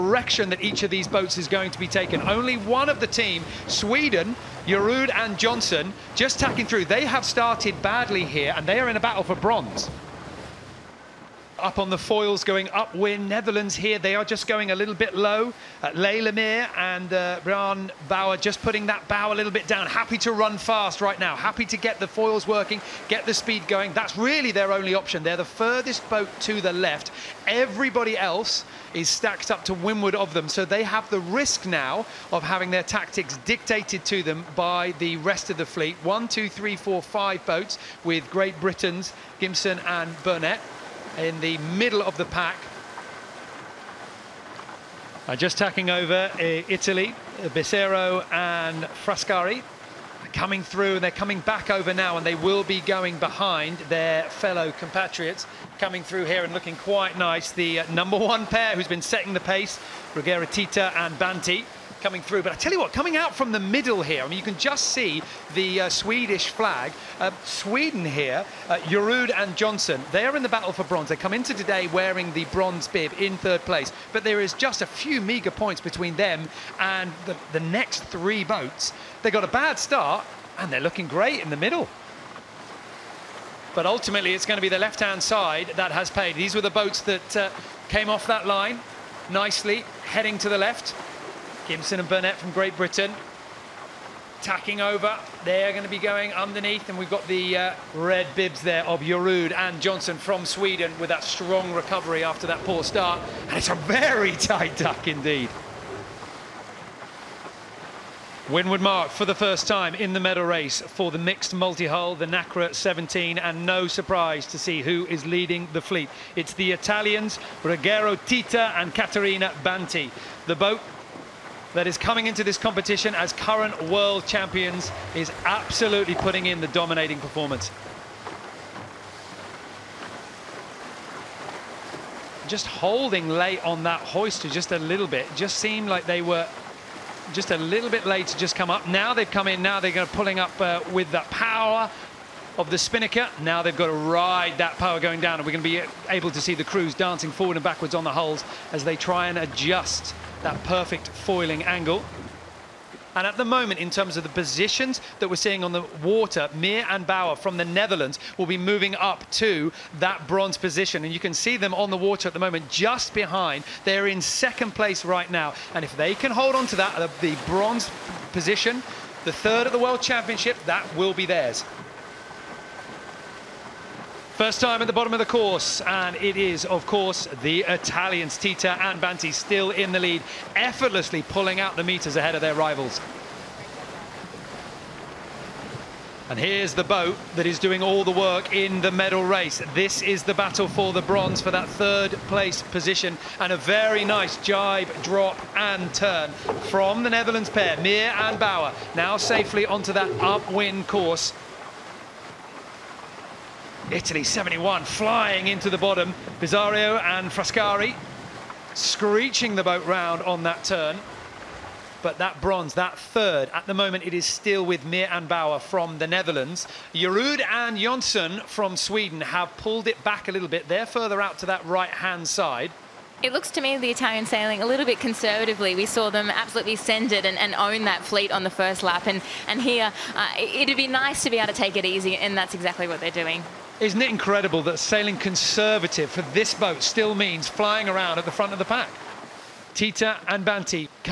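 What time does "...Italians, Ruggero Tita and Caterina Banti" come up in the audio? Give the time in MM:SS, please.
01:56.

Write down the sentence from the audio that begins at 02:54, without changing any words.
First time at the bottom of the course, and it is, of course, the Italians.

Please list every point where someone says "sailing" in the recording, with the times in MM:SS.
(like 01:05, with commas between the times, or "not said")
03:44, 03:54.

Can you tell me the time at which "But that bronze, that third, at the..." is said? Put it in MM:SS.
03:32.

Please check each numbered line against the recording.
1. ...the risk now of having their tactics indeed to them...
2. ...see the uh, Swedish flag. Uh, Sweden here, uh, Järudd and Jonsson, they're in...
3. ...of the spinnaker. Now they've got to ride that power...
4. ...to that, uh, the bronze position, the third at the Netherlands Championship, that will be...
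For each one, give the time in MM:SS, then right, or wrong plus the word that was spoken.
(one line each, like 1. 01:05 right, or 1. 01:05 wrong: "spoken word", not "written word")
1. 00:31 wrong: "dictated", not "indeed"
2. 01:04 right
3. 02:22 right
4. 02:46 wrong: "World", not "Netherlands".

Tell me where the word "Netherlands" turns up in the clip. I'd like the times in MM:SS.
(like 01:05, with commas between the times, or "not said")
00:13, 02:37, 03:17, 03:36.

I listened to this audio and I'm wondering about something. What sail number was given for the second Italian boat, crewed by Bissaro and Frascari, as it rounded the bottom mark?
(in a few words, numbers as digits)
71.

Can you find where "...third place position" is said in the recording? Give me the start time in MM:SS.
03:11.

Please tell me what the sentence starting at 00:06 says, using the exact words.
They have started badly here, and they are in a battle for bronze up on the foils going upwind.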